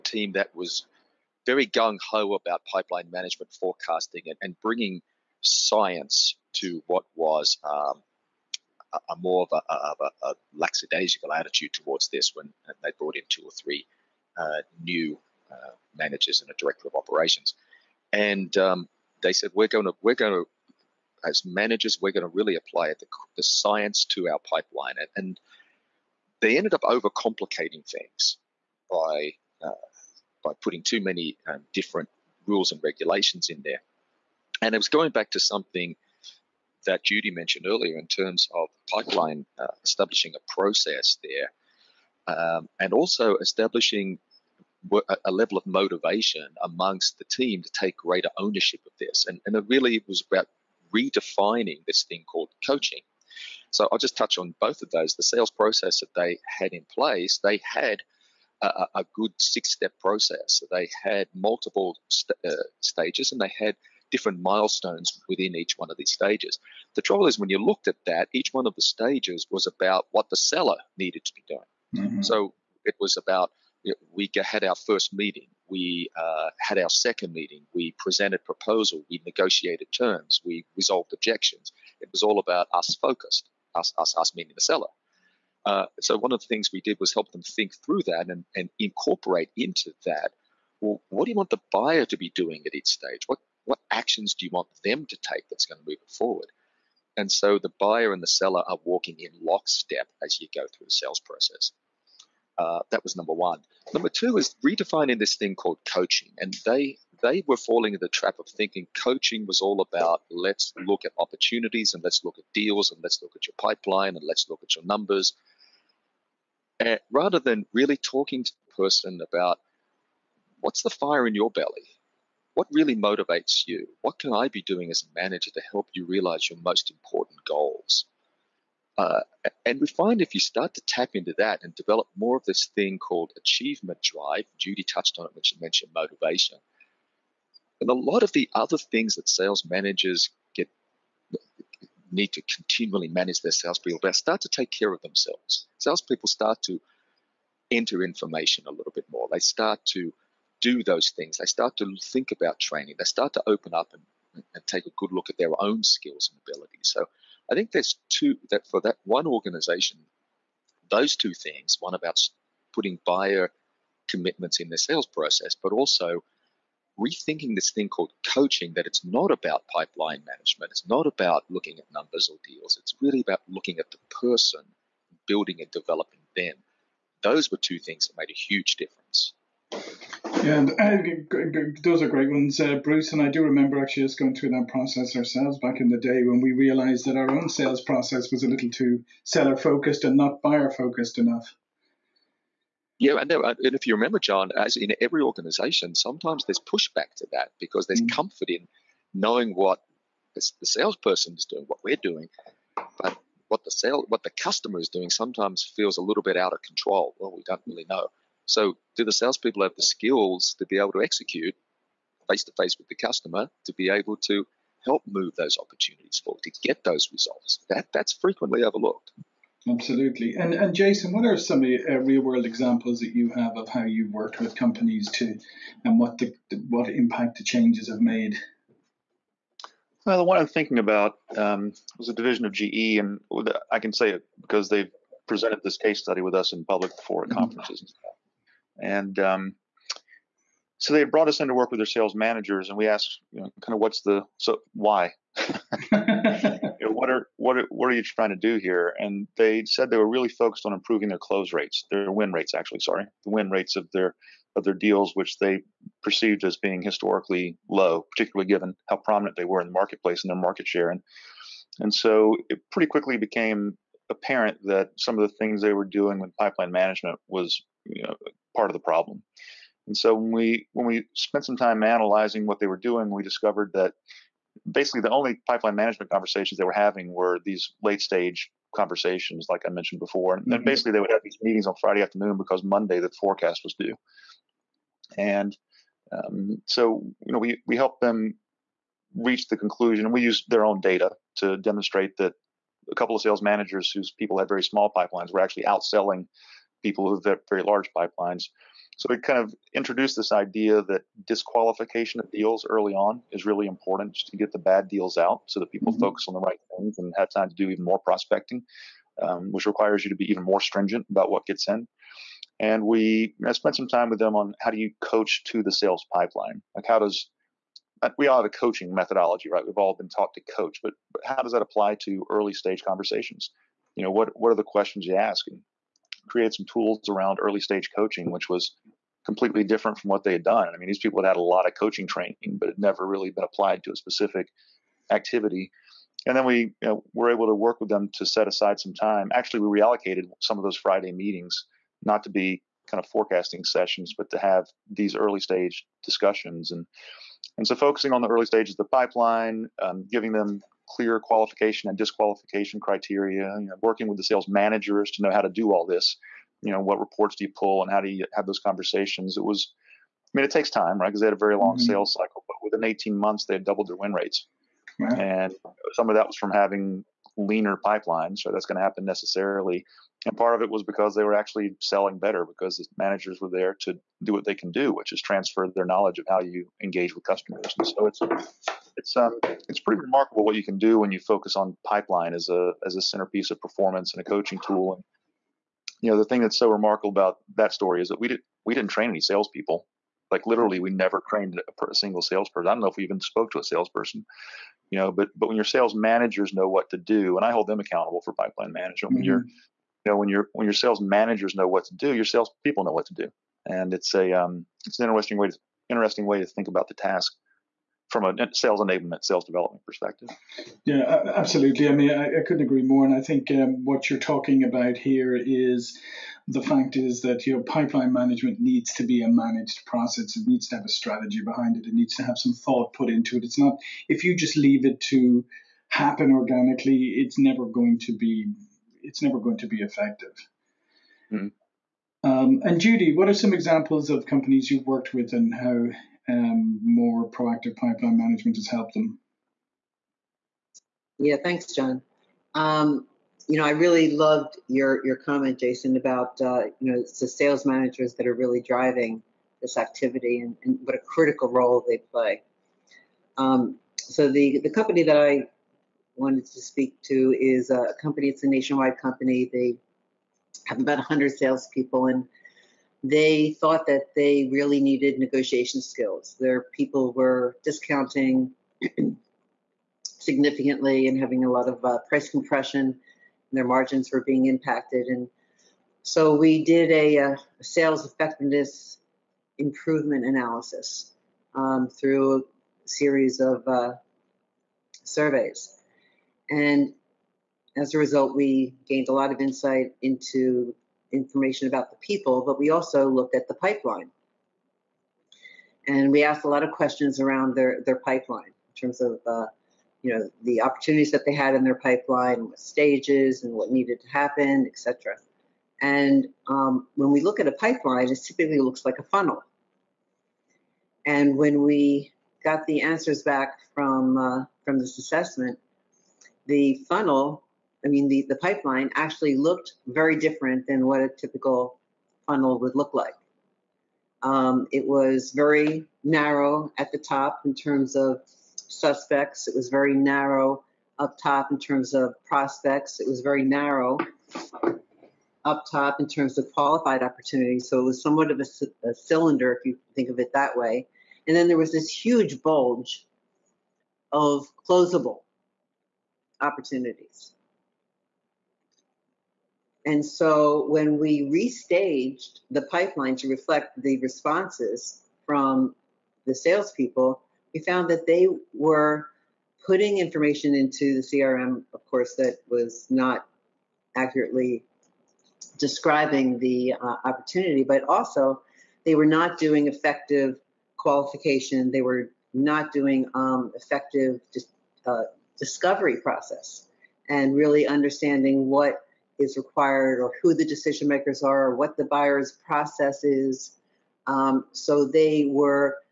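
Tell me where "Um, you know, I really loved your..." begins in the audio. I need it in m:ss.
7:22.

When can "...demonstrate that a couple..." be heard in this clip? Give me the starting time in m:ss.
4:51.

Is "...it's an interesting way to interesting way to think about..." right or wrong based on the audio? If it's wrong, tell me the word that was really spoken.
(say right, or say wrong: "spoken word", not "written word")
right.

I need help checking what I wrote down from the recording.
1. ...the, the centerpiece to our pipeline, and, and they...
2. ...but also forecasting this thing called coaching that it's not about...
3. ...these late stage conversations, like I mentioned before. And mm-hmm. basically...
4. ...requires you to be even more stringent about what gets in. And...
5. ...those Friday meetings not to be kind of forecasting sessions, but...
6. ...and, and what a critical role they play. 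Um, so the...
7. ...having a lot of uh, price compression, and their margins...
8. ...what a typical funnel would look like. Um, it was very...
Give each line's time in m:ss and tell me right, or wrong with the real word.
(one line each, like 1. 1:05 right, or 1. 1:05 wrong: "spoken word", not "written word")
1. 0:22 wrong: "science", not "centerpiece"
2. 2:45 wrong: "rethinking", not "forecasting"
3. 4:37 right
4. 5:09 right
5. 5:40 right
6. 7:30 right
7. 7:51 right
8. 8:40 right.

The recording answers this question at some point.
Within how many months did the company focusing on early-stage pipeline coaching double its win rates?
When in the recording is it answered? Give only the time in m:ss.
6:02.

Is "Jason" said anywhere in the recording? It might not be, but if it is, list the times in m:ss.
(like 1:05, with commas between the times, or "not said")
3:40, 7:25.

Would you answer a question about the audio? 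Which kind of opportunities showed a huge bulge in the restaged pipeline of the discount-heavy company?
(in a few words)
closable opportunities.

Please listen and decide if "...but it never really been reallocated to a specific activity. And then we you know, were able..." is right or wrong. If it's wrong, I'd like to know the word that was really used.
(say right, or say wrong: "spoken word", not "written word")
wrong: "applied", not "reallocated".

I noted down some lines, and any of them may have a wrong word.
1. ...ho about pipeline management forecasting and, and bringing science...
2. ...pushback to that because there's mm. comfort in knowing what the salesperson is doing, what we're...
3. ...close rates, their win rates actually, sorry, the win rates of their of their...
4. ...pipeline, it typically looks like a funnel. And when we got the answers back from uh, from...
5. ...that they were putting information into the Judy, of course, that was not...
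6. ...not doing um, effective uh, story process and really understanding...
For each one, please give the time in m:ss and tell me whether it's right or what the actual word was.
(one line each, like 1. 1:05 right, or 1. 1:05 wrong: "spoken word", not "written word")
1. 0:02 right
2. 3:16 right
3. 4:11 right
4. 8:27 right
5. 9:17 wrong: "CRM", not "Judy"
6. 9:32 wrong: "discovery", not "story".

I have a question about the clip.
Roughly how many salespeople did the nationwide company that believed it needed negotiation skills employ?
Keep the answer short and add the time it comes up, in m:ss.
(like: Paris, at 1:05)
100, at 7:40.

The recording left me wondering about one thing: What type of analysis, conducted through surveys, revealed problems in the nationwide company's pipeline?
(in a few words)
sales effectiveness improvement analysis.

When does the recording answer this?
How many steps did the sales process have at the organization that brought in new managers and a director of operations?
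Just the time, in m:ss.
0:59.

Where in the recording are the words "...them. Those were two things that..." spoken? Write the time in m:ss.
2:56.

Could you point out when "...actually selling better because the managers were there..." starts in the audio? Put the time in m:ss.
6:11.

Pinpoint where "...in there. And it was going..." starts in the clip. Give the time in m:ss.
0:33.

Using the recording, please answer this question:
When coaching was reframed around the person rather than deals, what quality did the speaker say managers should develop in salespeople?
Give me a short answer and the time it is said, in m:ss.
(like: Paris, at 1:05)
achievement drive, at 2:13.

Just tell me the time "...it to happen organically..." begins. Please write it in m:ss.
7:04.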